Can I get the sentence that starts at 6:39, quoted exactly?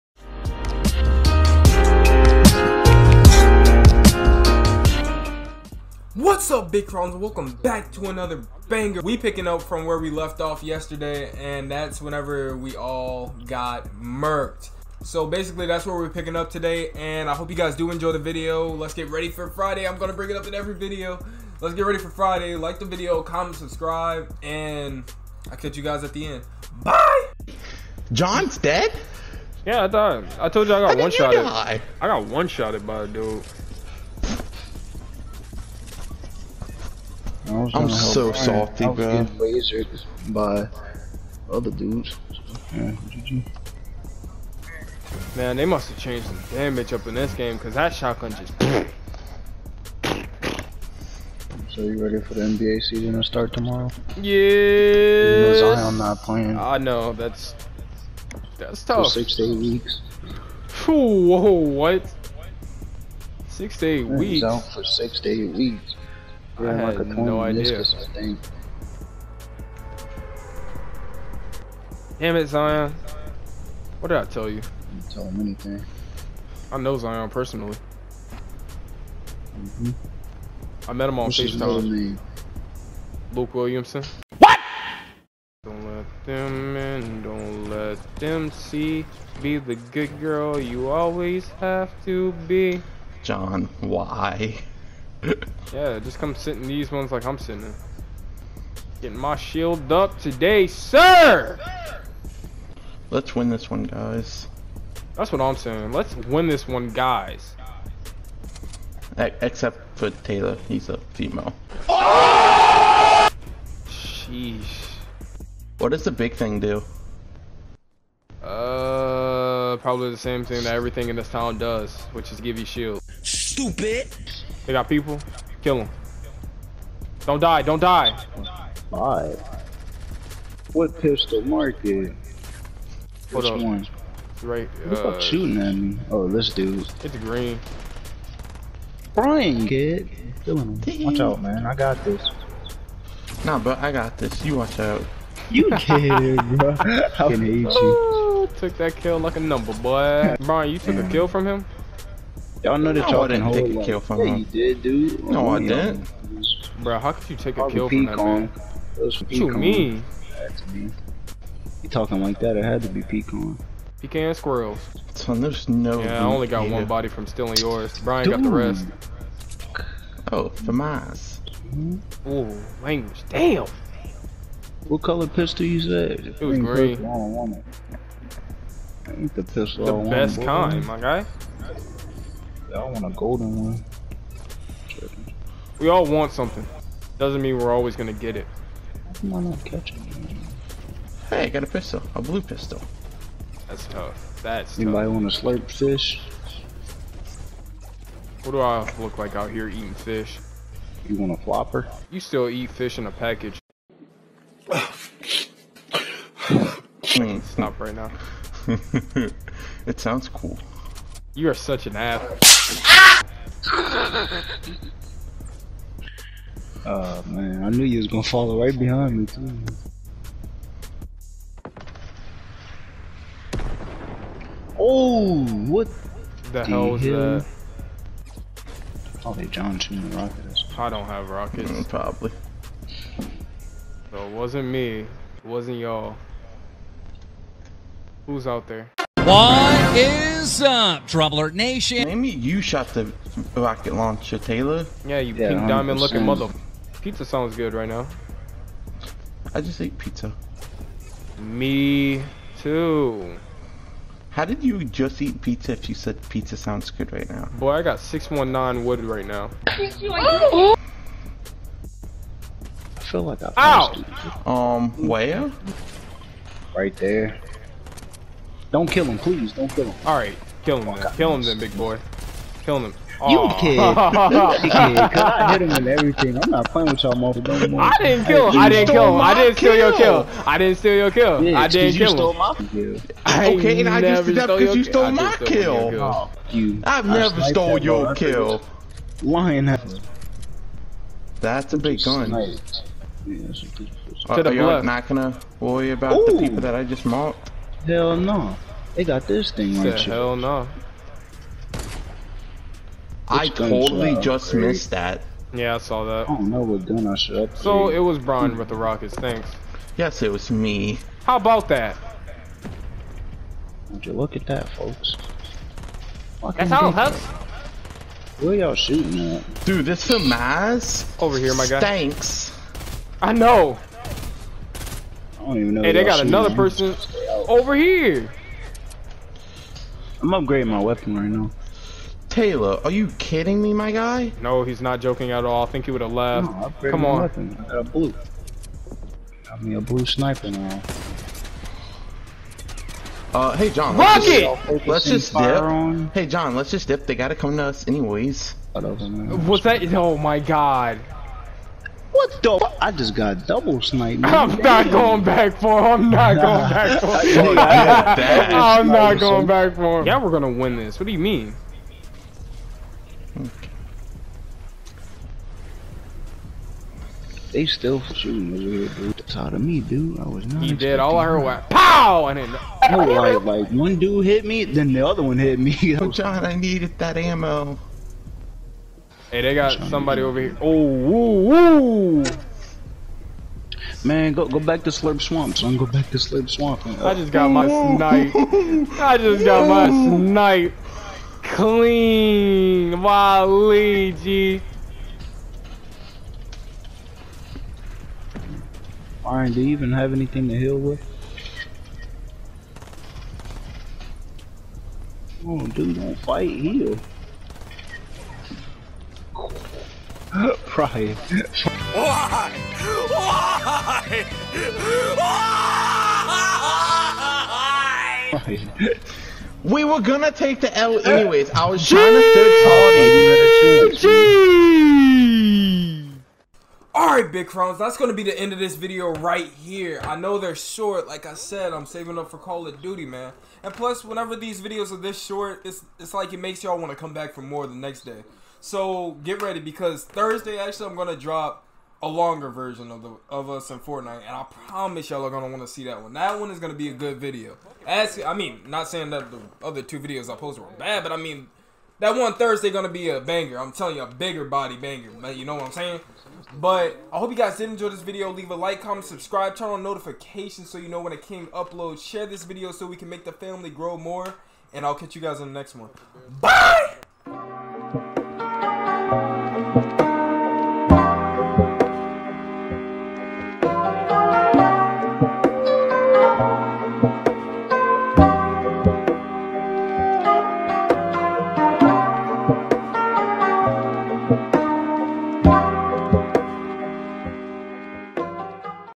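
Fine, do you even have anything to heal with?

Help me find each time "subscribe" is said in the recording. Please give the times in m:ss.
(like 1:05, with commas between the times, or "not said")
0:23, 7:39.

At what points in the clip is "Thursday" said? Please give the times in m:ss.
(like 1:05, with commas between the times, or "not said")
7:20, 7:32.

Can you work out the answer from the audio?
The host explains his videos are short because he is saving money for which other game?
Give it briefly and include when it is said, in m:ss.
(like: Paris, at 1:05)
Call of Duty, at 7:12.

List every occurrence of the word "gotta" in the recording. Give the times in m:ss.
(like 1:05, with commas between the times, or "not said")
5:47.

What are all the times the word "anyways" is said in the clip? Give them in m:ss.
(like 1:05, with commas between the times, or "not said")
5:47, 7:01.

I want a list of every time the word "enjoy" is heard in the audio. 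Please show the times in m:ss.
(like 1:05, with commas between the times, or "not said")
0:17, 7:37.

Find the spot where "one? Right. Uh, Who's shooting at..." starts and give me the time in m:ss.
2:13.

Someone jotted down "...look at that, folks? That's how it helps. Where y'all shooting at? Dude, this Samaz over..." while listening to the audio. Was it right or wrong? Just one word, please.
right.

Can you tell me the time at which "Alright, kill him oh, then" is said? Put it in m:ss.
4:30.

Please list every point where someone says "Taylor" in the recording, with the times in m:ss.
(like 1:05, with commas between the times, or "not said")
1:50, 4:04, 5:32.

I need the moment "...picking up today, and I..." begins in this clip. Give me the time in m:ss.
0:16.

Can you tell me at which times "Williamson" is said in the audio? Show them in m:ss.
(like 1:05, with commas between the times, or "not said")
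1:23.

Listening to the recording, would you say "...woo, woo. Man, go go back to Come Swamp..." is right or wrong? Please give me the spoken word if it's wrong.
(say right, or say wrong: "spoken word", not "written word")
wrong: "Slurp", not "Come".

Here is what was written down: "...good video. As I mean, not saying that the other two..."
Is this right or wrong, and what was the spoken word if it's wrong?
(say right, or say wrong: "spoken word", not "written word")
right.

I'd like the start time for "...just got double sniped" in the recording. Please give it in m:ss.
5:52.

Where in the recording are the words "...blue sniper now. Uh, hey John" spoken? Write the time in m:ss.
5:39.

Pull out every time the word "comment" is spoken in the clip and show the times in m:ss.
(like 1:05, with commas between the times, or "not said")
0:23, 7:38.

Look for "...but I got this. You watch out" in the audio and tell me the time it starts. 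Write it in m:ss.
2:23.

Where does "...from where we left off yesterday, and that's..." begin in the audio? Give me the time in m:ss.
0:09.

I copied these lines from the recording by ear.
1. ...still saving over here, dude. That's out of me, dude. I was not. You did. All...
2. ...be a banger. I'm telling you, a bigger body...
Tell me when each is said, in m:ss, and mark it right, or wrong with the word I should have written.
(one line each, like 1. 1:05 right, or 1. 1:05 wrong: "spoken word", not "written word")
1. 6:07 wrong: "shooting", not "saving"
2. 7:32 right.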